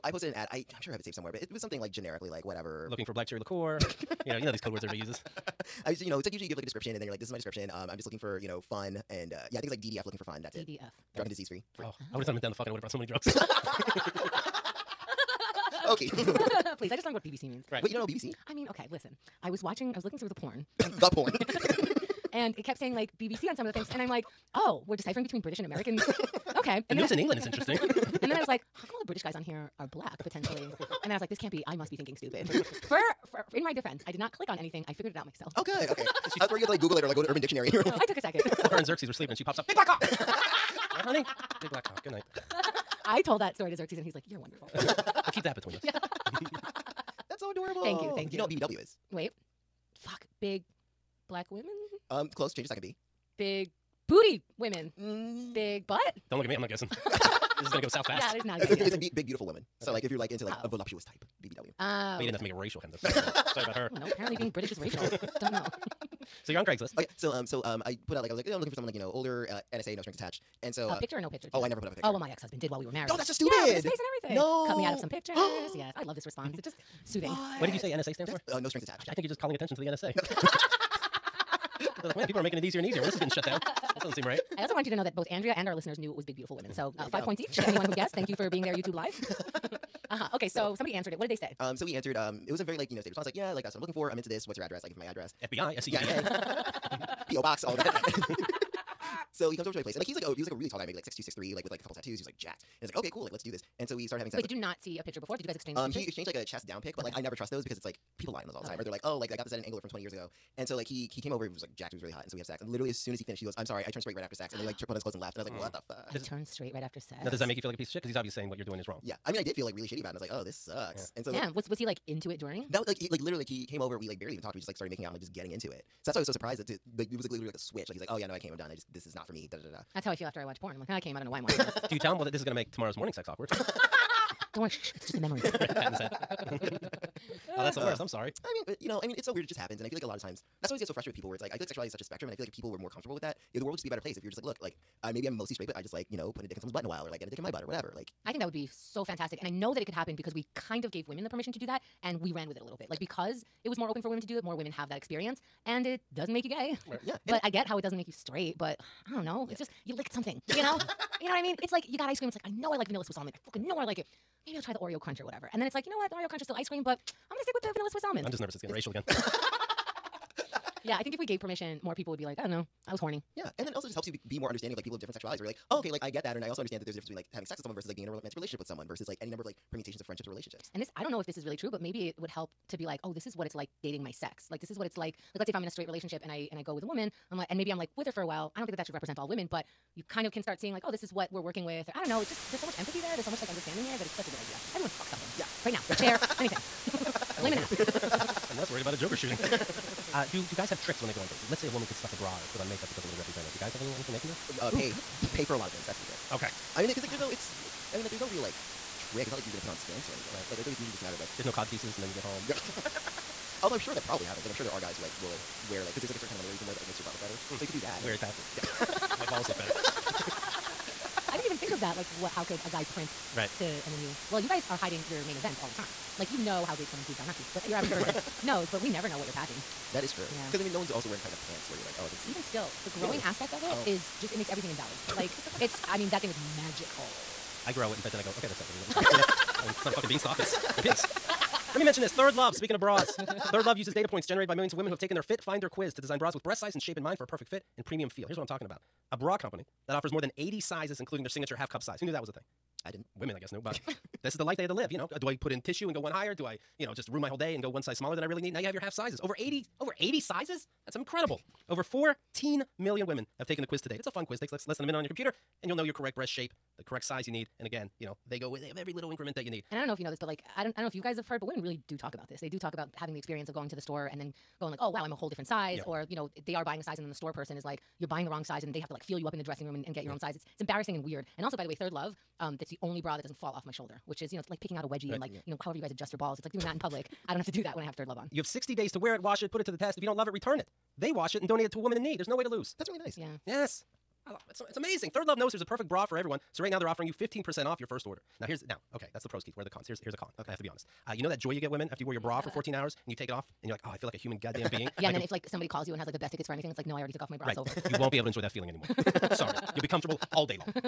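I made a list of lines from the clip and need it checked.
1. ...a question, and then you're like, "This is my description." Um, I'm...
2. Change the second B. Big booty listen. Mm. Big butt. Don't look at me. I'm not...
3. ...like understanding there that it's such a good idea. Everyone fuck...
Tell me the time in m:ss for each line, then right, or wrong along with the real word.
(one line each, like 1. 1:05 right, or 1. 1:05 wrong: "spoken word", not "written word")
1. 0:06 wrong: "description", not "question"
2. 0:52 wrong: "women", not "listen"
3. 3:13 right.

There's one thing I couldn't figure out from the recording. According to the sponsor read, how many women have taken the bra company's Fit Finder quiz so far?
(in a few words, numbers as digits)
Over 14 million.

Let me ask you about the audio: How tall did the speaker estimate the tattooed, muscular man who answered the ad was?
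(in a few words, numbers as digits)
6'2" to 6'3".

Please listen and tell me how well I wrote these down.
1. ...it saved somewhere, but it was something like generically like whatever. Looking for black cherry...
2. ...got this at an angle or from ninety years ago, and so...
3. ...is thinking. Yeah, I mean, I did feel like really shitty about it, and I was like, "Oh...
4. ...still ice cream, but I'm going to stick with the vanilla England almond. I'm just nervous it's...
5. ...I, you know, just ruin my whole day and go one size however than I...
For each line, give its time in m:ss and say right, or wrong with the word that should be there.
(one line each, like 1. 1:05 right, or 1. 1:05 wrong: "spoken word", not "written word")
1. 0:00 right
2. 1:49 wrong: "twenty", not "ninety"
3. 1:58 wrong: "wrong", not "thinking"
4. 2:46 wrong: "Swiss", not "England"
5. 4:16 wrong: "smaller", not "however".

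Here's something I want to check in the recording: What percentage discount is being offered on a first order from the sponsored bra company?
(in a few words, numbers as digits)
15%.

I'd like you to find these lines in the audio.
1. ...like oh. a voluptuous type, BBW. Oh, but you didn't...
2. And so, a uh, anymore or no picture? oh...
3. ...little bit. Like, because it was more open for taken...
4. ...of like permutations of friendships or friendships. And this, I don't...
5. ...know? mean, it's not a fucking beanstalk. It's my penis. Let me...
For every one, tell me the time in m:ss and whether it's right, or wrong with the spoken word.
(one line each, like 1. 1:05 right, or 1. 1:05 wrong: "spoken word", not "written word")
1. 1:00 right
2. 1:10 wrong: "picture", not "anymore"
3. 2:32 wrong: "women", not "taken"
4. 2:59 wrong: "relationships", not "friendships"
5. 3:59 right.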